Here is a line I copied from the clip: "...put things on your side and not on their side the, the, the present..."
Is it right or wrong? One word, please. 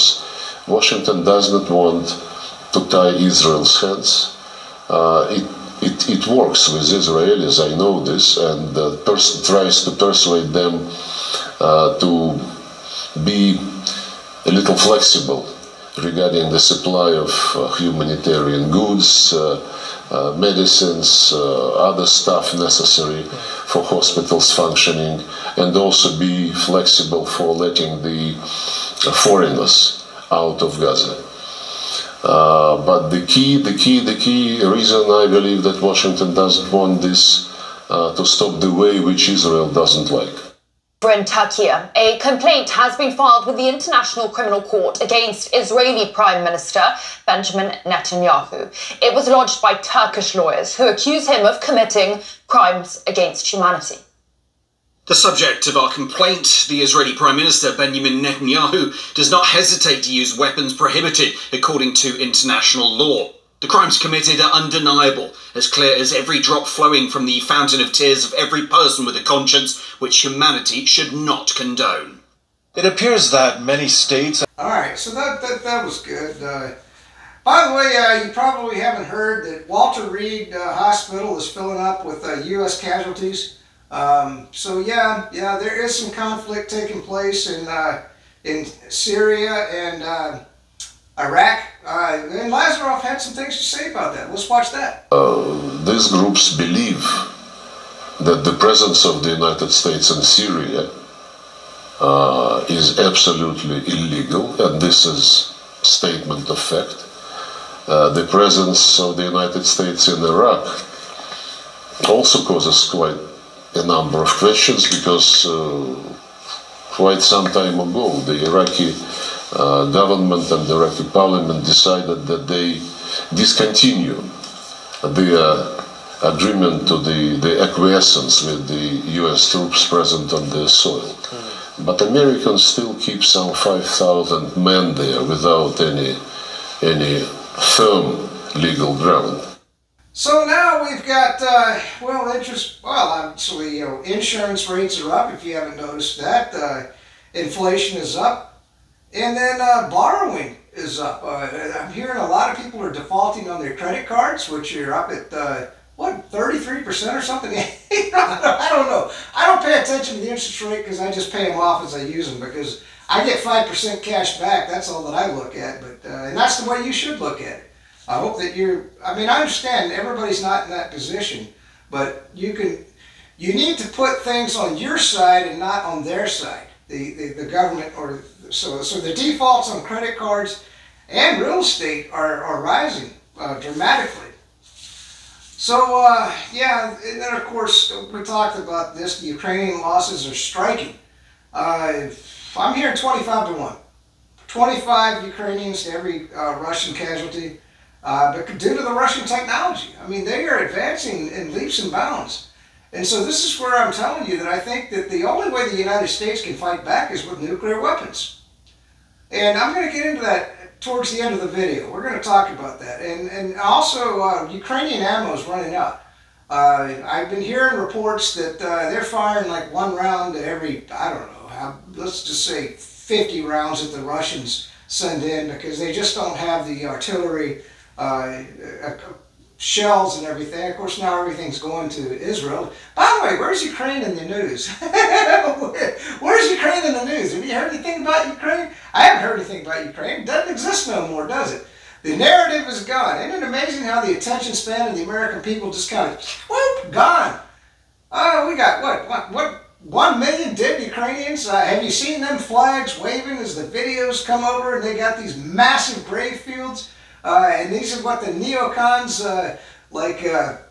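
wrong.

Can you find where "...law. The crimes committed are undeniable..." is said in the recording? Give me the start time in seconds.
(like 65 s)
62 s.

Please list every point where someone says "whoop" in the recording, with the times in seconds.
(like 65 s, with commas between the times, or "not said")
246 s.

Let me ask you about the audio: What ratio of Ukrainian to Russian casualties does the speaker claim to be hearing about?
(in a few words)
25 to 1.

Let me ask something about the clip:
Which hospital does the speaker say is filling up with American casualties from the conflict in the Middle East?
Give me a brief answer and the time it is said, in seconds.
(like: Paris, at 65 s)
Walter Reed, at 79 s.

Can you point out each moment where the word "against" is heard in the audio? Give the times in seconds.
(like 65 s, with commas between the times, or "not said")
45 s, 53 s.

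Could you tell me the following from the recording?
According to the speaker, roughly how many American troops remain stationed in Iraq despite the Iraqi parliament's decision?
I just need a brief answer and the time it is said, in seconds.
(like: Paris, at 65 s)
5,000, at 133 s.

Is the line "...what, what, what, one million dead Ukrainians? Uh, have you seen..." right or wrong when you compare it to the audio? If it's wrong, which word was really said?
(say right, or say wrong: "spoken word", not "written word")
right.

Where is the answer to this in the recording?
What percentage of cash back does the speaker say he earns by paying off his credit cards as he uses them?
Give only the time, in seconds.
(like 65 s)
163 s.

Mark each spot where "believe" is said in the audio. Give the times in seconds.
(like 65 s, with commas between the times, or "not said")
35 s, 96 s.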